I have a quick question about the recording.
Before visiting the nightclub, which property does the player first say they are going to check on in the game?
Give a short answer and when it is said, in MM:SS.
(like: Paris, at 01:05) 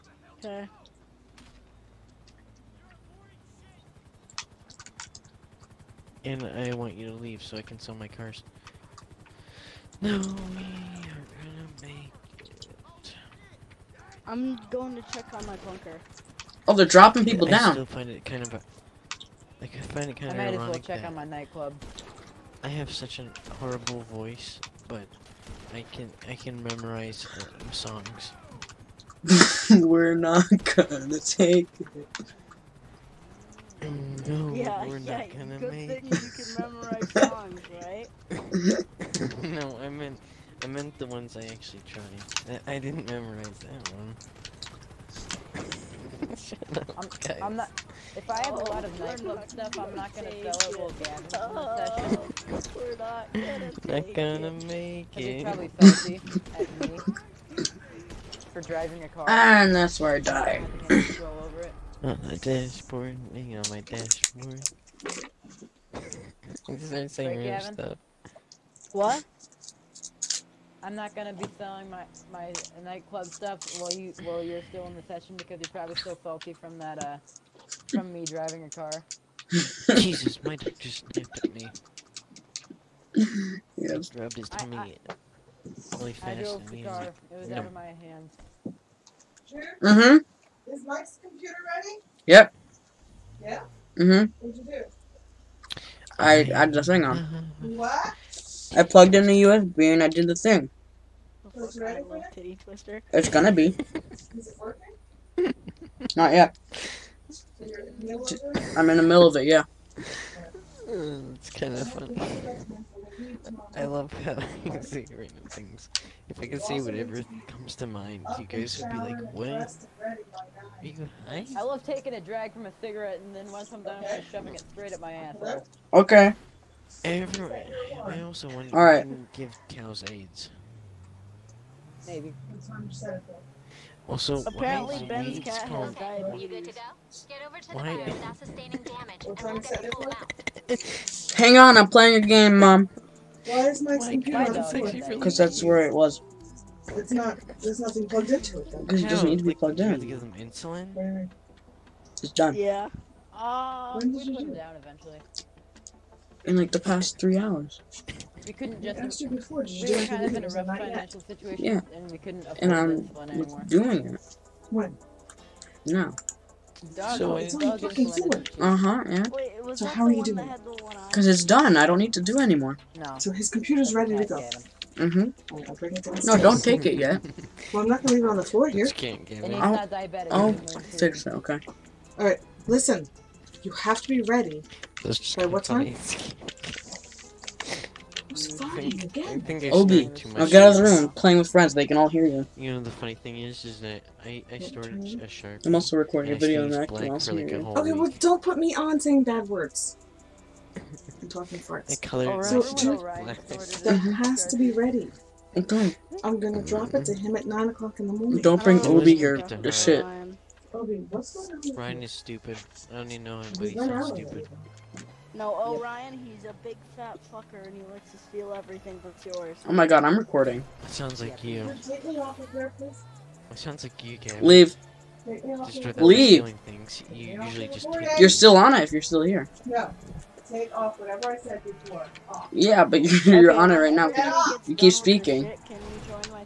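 bunker, at 00:15.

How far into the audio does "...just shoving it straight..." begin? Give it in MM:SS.
02:04.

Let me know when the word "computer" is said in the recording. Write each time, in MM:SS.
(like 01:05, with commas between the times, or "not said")
01:31, 02:24, 02:53.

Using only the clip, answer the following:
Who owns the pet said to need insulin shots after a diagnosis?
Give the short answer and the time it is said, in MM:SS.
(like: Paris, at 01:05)
Ben, at 02:15.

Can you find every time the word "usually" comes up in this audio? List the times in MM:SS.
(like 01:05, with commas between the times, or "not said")
03:47.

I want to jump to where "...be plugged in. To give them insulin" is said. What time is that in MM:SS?
02:29.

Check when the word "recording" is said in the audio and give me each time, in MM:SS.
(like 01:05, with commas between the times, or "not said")
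03:15, 03:40.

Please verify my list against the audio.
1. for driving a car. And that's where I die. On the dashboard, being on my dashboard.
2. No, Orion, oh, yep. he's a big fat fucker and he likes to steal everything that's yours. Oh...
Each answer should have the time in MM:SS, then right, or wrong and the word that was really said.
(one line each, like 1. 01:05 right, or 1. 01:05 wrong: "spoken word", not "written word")
1. 00:58 right
2. 03:35 right.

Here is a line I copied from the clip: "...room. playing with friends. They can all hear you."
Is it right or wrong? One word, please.
right.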